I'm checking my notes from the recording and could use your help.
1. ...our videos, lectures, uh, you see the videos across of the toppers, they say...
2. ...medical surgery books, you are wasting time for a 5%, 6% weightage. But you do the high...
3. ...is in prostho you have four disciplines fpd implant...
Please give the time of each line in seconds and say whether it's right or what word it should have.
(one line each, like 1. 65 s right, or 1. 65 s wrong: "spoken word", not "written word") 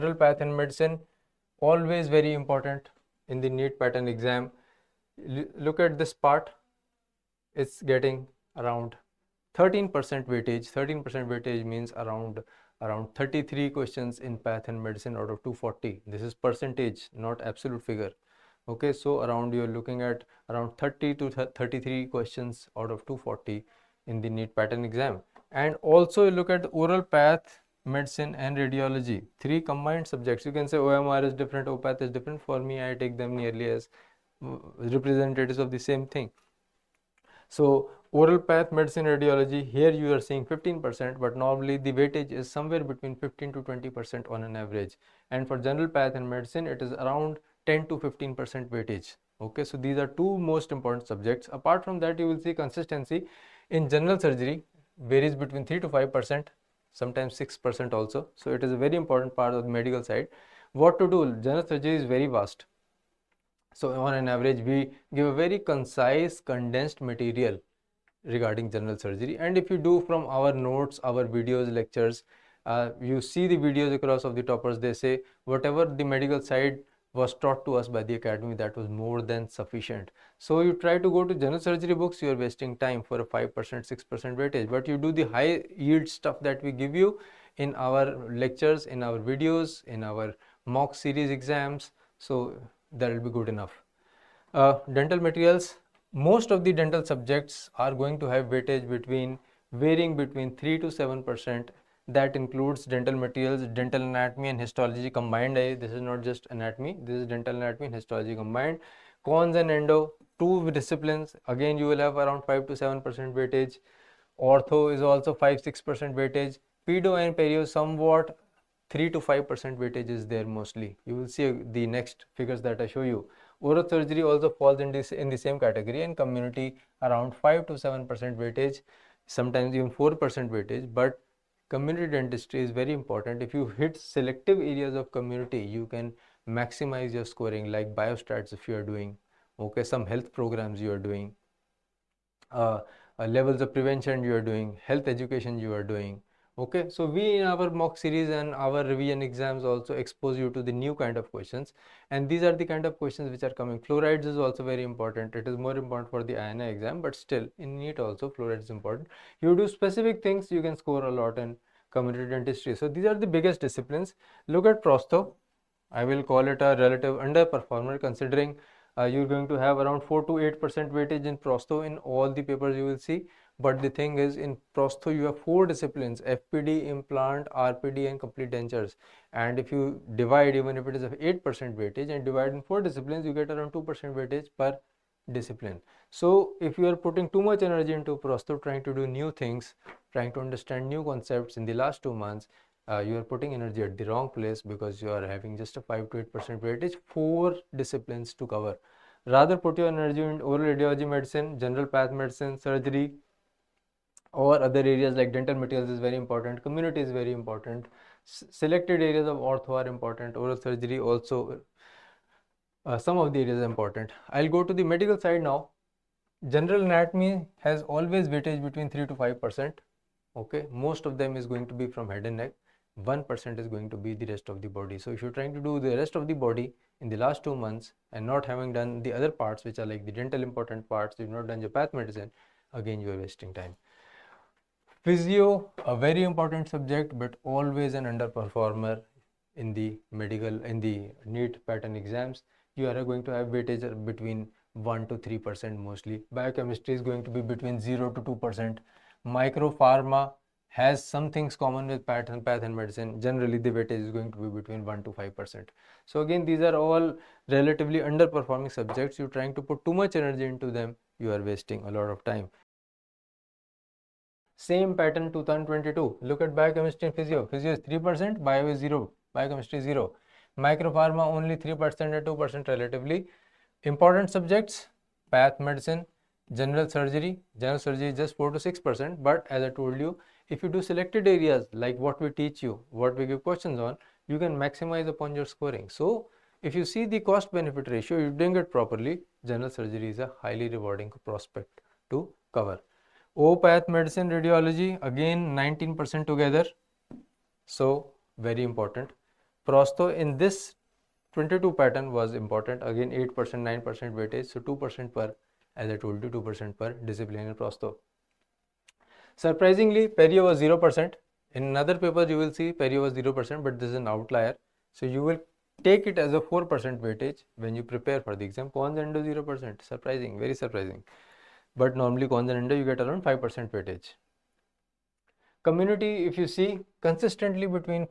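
1. 71 s right
2. 81 s wrong: "general", not "medical"
3. 174 s right.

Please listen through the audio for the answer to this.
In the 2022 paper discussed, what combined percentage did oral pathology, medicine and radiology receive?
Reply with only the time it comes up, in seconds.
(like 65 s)
295 s.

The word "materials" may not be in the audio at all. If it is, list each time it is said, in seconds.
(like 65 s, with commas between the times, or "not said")
67 s, 95 s, 103 s, 205 s.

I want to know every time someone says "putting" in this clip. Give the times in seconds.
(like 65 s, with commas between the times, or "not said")
186 s, 193 s.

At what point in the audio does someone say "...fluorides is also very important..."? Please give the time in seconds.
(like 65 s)
153 s.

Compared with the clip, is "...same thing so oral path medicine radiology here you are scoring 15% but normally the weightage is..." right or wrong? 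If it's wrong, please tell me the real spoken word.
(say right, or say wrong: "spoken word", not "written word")
wrong: "seeing", not "scoring".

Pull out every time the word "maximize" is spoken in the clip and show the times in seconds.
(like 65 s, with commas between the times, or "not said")
136 s, 284 s.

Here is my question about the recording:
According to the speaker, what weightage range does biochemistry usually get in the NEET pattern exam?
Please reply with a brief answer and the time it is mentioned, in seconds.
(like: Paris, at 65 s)
0 to 2%, at 247 s.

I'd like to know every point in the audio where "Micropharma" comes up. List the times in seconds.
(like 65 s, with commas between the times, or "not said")
249 s, 270 s.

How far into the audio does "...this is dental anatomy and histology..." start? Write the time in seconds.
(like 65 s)
107 s.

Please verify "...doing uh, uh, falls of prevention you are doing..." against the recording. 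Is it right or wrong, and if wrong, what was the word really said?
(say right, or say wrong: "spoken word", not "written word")
wrong: "levels", not "falls".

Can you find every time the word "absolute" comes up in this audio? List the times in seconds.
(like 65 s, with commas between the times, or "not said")
17 s.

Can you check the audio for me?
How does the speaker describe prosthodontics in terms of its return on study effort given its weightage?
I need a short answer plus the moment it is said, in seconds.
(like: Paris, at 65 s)
Relative underperformer, at 166 s.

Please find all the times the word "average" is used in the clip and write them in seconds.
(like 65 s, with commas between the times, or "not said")
44 s, 64 s.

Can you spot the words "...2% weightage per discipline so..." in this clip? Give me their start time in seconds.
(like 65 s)
183 s.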